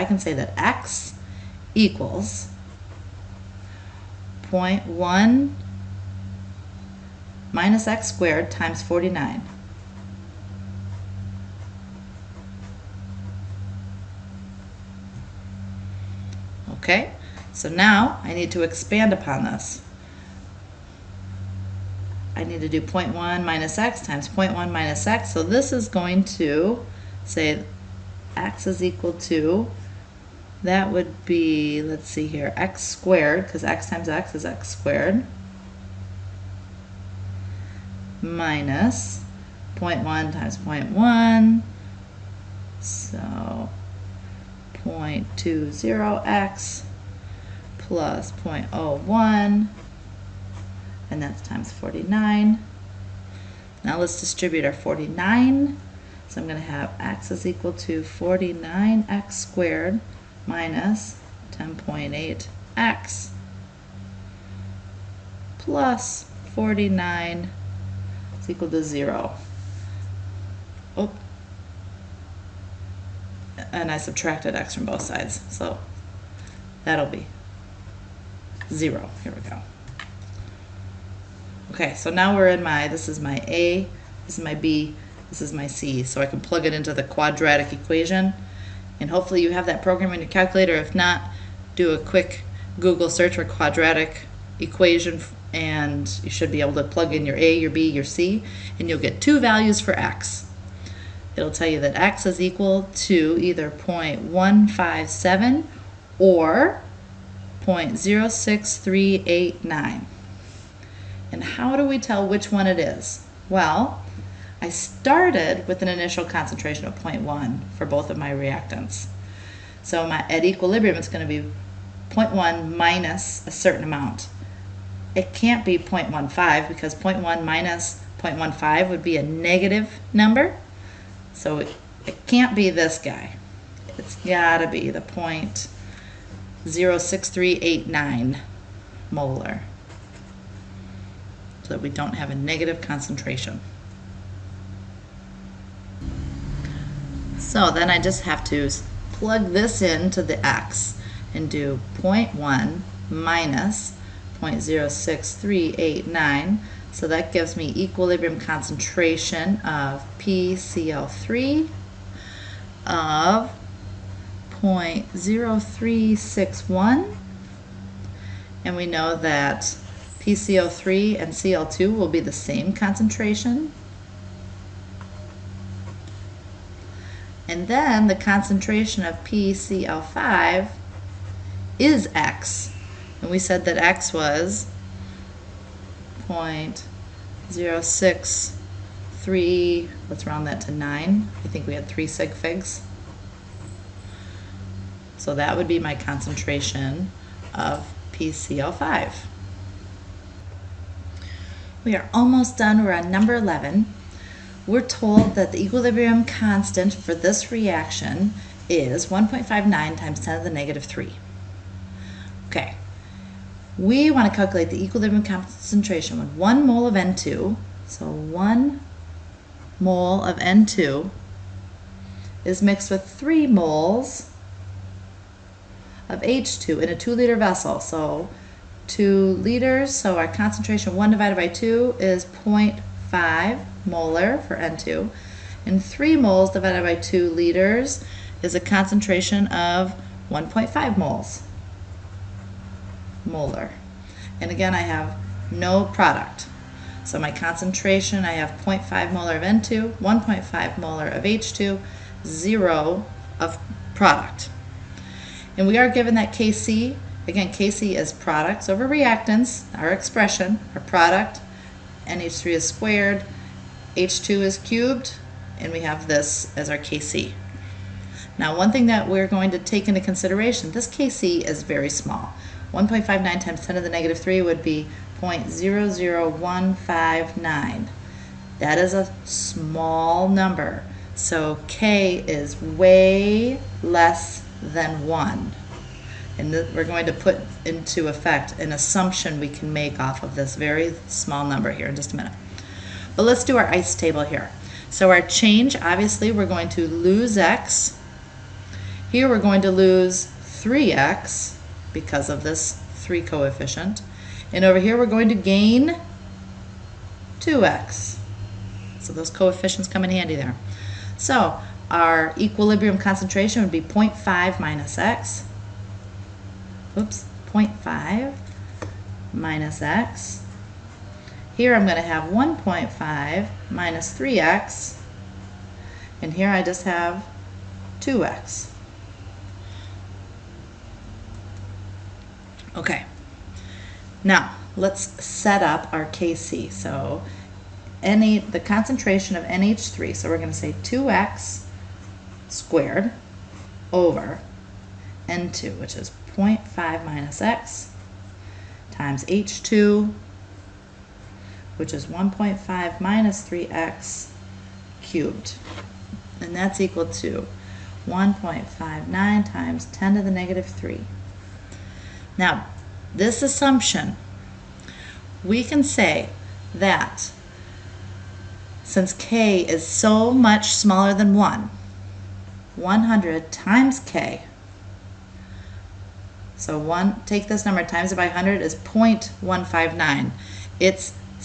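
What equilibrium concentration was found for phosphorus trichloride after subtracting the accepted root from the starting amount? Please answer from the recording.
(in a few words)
0.0361.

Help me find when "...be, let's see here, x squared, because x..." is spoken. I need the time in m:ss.
0:31.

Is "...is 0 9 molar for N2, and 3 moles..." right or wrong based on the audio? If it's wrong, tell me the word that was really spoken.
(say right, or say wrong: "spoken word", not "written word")
wrong: "5", not "9".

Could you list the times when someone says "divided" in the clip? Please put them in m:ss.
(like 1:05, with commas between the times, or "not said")
3:51, 3:56.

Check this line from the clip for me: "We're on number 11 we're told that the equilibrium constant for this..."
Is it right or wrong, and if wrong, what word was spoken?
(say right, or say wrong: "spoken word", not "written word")
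right.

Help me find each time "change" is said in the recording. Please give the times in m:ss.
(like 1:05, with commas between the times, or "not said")
4:55.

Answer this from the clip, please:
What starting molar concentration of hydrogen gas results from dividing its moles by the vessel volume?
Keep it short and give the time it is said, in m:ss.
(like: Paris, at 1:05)
1.5 molar, at 4:00.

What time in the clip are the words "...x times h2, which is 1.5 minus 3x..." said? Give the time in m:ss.
5:47.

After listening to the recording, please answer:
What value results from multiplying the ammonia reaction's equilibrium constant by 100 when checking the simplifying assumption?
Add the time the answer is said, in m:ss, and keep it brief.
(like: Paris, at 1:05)
0.159, at 6:18.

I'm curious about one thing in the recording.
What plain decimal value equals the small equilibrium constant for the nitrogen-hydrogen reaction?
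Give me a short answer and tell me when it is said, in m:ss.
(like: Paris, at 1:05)
0.00159, at 4:35.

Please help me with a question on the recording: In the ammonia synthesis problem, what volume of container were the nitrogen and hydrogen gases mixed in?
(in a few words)
2 liters.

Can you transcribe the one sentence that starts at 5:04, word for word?
And over here we're going to gain 2x.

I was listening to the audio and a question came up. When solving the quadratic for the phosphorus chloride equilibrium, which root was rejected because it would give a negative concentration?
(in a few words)
0.157.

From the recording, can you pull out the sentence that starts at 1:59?
So my, at equilibrium, it's going to be 0.1 minus a certain amount.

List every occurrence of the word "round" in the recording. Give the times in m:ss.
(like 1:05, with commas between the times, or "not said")
3:10.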